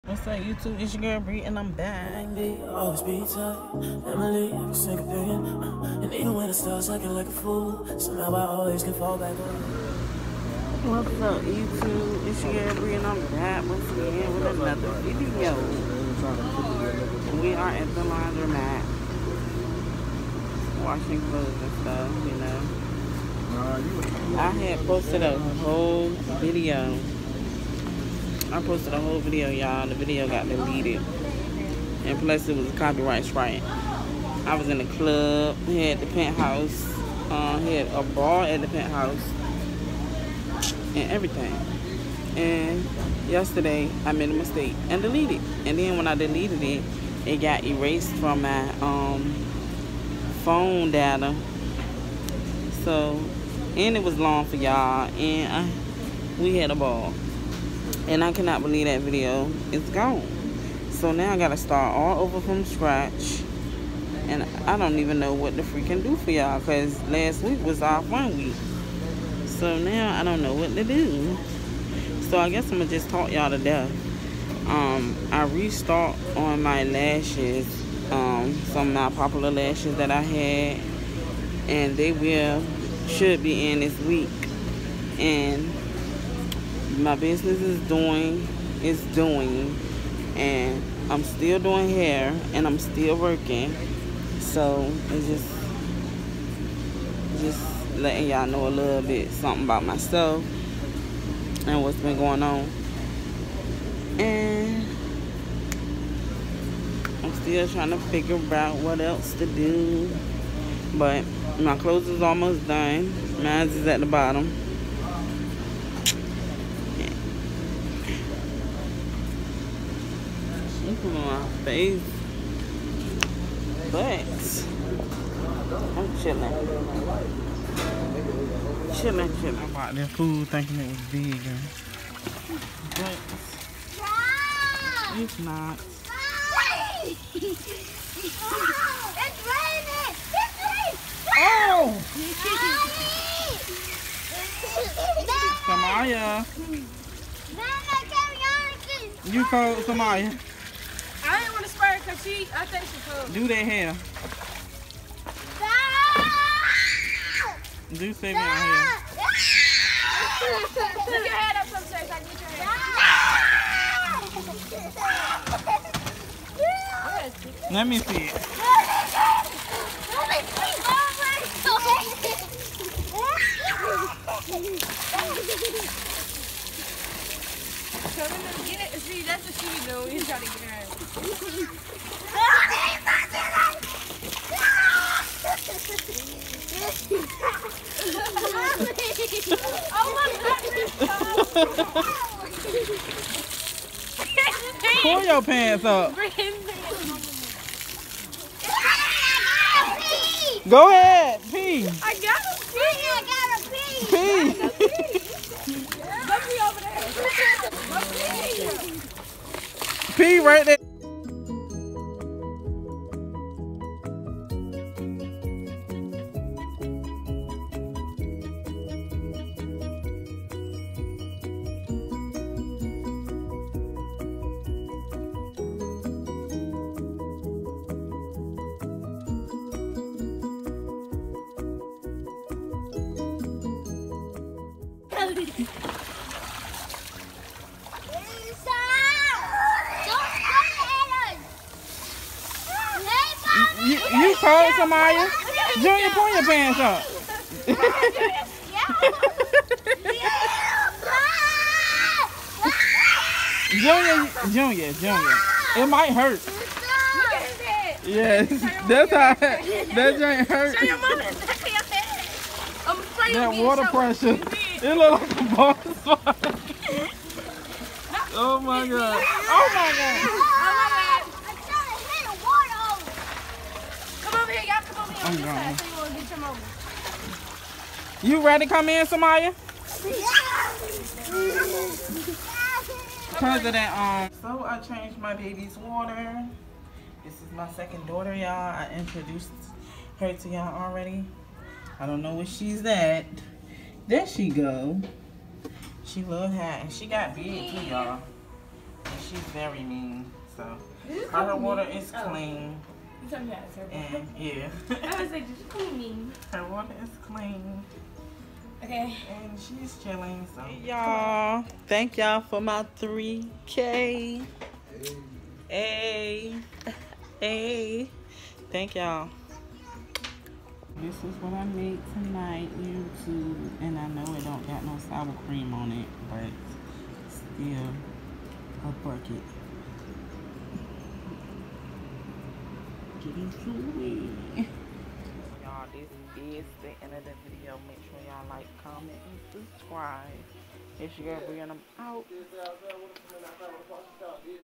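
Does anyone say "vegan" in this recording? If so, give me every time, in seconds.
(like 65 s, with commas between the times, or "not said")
131 s.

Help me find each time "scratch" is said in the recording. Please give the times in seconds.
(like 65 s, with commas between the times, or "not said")
62 s.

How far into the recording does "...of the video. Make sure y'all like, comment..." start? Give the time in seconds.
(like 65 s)
337 s.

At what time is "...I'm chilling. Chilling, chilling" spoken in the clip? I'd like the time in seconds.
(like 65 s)
125 s.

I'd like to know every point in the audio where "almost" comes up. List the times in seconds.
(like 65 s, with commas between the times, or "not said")
112 s.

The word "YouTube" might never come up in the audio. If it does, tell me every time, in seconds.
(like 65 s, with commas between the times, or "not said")
0 s, 11 s, 322 s.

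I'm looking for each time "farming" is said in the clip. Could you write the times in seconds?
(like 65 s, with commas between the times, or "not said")
not said.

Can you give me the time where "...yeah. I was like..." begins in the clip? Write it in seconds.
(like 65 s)
304 s.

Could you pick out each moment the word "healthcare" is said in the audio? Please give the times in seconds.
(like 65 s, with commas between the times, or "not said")
not said.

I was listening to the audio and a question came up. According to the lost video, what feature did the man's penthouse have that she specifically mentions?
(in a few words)
a bar.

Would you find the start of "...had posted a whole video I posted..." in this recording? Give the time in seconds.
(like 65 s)
24 s.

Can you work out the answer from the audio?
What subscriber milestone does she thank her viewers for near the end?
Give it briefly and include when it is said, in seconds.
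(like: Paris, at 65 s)
3K, at 312 s.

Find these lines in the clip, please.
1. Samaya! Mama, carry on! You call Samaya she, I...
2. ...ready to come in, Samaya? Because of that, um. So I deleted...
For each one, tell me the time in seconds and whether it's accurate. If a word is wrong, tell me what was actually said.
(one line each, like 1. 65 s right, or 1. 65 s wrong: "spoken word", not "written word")
1. 145 s right
2. 278 s wrong: "changed", not "deleted".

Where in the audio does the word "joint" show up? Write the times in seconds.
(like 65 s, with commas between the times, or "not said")
260 s.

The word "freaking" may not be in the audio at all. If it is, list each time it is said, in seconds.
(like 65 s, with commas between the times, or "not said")
65 s.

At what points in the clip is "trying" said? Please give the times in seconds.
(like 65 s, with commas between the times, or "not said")
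107 s, 180 s.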